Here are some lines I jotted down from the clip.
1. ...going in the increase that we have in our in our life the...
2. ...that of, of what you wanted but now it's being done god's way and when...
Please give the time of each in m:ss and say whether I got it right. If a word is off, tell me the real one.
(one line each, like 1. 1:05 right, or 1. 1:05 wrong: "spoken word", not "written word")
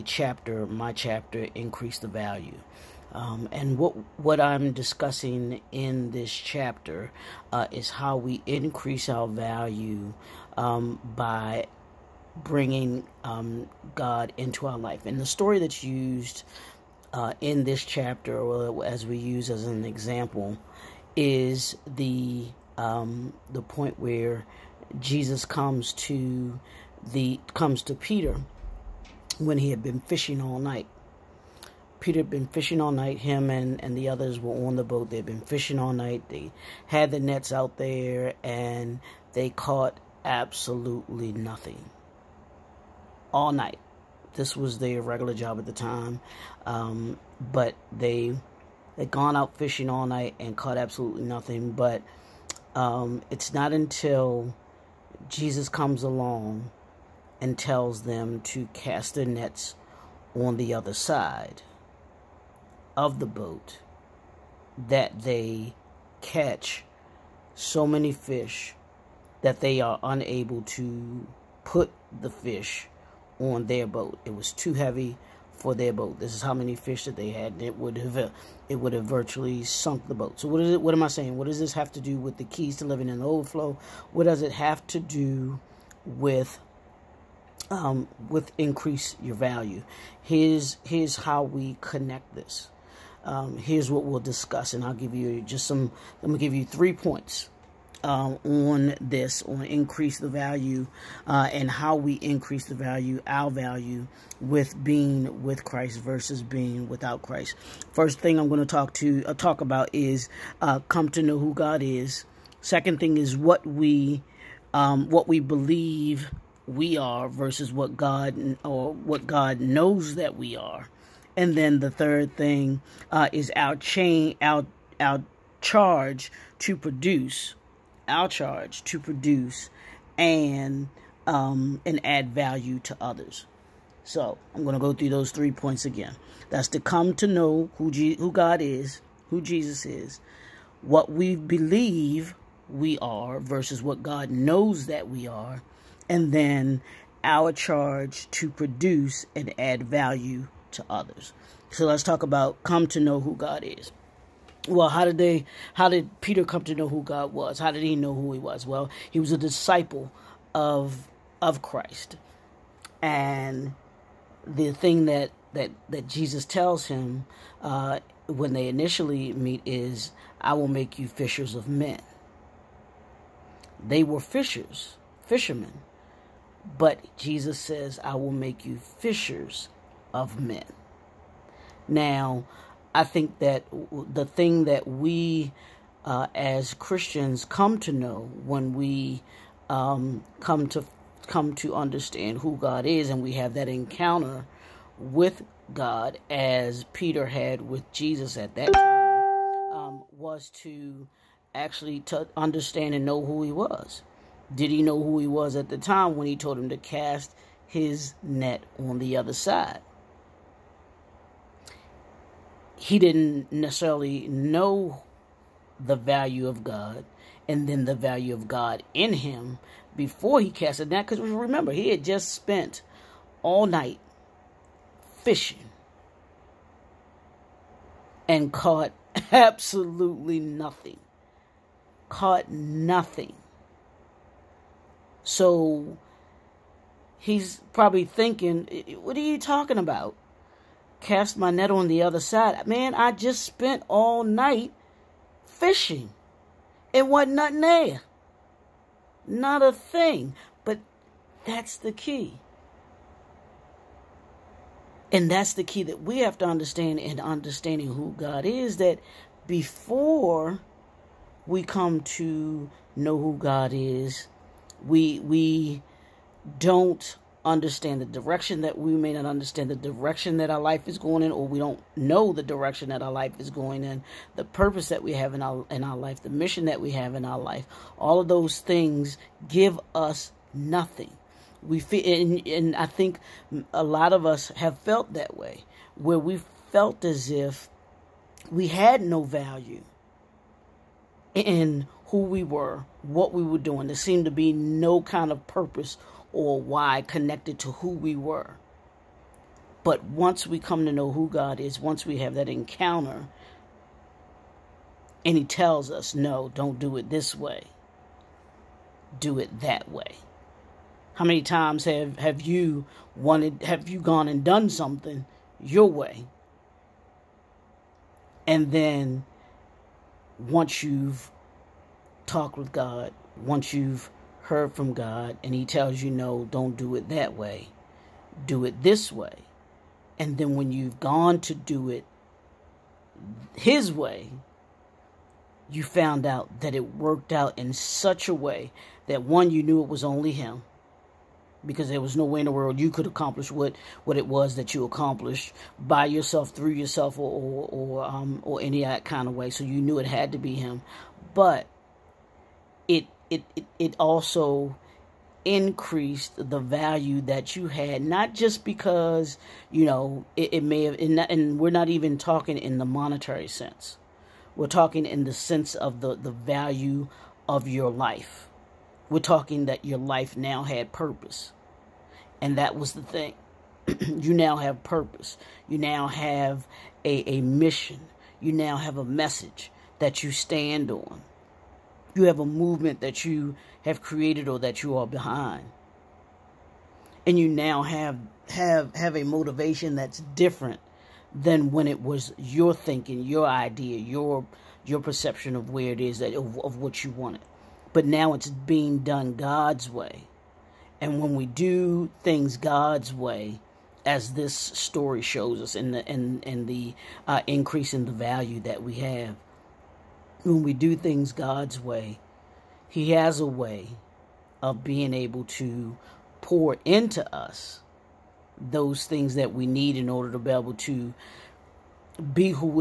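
1. 4:33 wrong: "purpose", not "increase"
2. 6:36 right.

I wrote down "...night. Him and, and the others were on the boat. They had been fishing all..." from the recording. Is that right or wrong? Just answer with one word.
right.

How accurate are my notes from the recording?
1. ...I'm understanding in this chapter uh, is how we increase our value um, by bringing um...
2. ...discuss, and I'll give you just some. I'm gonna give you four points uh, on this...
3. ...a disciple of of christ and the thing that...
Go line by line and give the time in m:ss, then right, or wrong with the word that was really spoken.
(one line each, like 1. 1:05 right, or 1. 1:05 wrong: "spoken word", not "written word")
1. 0:04 wrong: "discussing", not "understanding"
2. 1:34 wrong: "three", not "four"
3. 2:39 right.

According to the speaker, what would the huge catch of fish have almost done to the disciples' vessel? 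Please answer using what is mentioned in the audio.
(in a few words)
Sunk the boat.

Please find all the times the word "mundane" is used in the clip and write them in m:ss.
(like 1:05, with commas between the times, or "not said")
not said.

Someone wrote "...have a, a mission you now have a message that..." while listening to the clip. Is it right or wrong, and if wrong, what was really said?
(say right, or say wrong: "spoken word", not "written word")
right.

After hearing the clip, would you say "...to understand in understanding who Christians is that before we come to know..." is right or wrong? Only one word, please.
wrong.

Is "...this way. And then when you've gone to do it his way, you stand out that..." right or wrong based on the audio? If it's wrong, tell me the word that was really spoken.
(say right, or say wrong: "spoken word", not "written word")
wrong: "found", not "stand".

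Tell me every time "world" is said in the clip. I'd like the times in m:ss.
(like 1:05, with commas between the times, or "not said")
5:42.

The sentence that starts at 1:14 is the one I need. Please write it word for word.
It was too heavy for their boat.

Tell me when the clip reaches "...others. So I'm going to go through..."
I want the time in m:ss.
2:12.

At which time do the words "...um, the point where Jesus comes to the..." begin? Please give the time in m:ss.
0:22.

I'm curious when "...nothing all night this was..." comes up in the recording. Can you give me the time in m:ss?
0:41.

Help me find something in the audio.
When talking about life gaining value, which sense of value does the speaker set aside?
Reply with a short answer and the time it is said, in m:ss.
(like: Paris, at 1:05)
Monetary sense, at 6:02.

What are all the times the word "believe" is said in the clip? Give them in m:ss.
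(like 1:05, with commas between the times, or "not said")
1:55, 2:21.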